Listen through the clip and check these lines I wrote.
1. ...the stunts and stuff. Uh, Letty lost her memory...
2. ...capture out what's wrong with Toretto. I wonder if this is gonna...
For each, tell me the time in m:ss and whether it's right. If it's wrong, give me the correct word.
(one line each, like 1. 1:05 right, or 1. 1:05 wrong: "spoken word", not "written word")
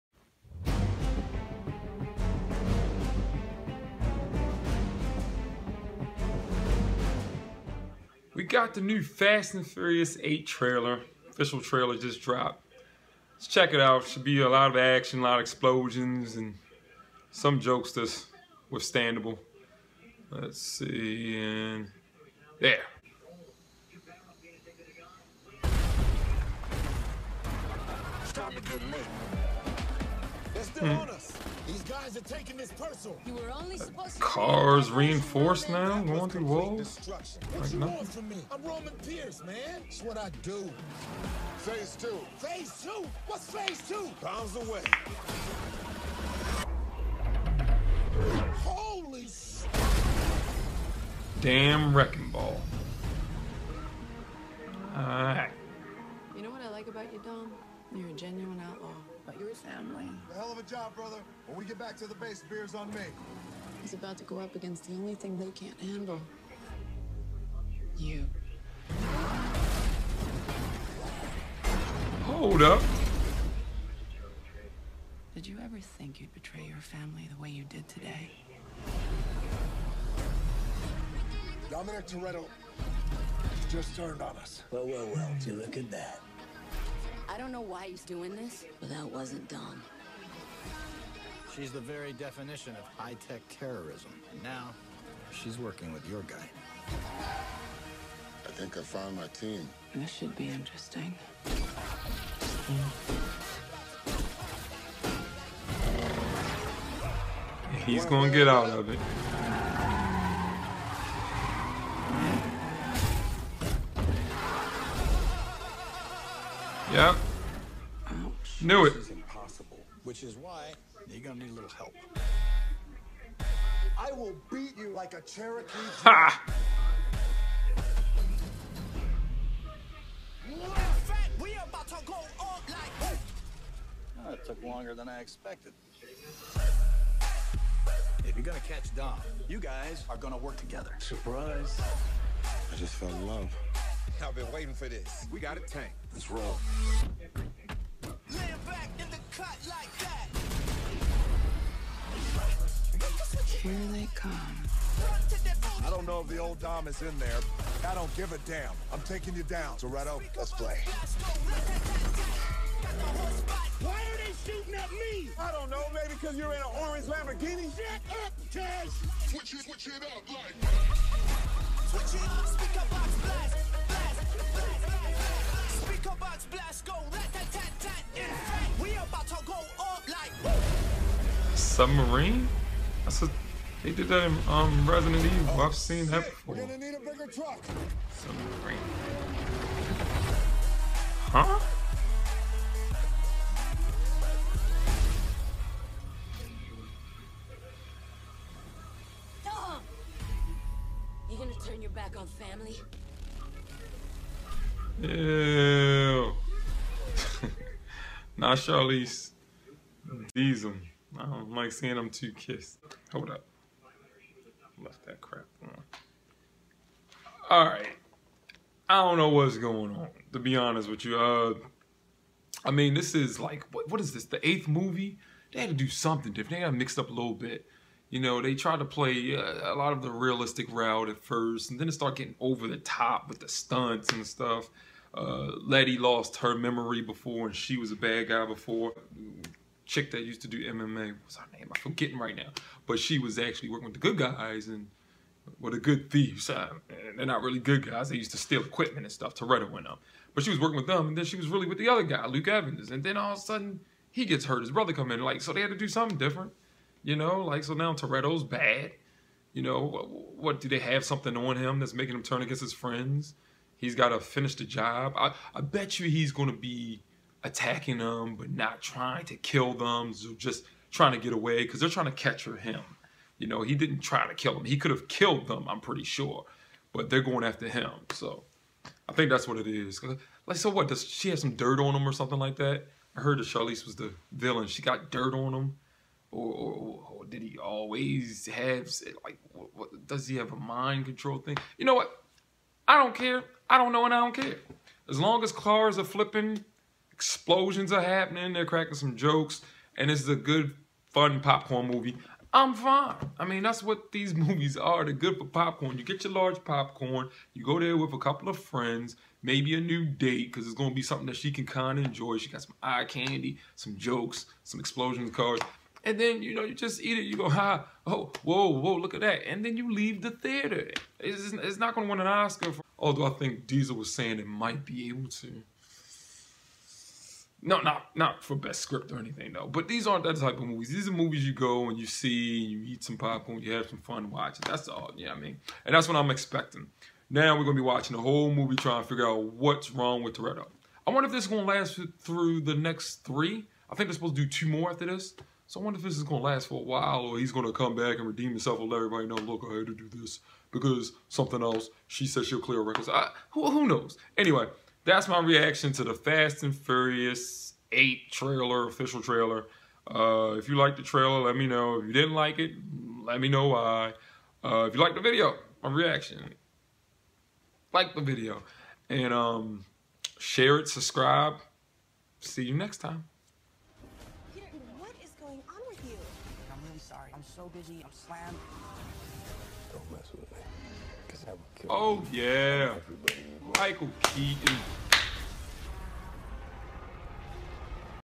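1. 3:53 right
2. 5:39 wrong: "figure", not "capture".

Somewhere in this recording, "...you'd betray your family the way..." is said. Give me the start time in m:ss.
1:16.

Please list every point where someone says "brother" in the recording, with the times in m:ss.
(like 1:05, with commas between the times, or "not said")
1:00, 4:14.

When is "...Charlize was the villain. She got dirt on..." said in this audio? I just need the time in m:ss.
4:43.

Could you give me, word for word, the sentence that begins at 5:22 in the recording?
For although I think Diesel was saying it might be able to.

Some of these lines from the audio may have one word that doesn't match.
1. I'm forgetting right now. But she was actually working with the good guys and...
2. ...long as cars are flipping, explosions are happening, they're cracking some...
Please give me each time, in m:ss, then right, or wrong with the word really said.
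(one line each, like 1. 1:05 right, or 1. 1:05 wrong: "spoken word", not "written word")
1. 4:01 right
2. 4:55 right.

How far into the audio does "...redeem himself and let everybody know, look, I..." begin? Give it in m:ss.
5:48.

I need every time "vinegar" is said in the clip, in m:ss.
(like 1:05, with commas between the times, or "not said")
not said.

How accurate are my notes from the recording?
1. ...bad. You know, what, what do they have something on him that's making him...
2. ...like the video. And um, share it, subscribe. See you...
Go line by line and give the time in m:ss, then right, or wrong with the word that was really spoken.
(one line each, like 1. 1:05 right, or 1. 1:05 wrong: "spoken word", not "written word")
1. 4:18 right
2. 6:07 right.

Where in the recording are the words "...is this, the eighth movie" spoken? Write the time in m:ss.
3:44.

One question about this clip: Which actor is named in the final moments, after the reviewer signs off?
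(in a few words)
Michael Keaton.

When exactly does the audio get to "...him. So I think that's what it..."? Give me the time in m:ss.
4:37.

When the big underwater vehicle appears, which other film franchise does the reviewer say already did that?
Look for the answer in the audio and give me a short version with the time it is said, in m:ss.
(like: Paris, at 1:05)
Resident Evil, at 3:04.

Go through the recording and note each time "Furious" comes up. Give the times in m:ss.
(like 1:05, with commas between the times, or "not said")
0:09, 5:56.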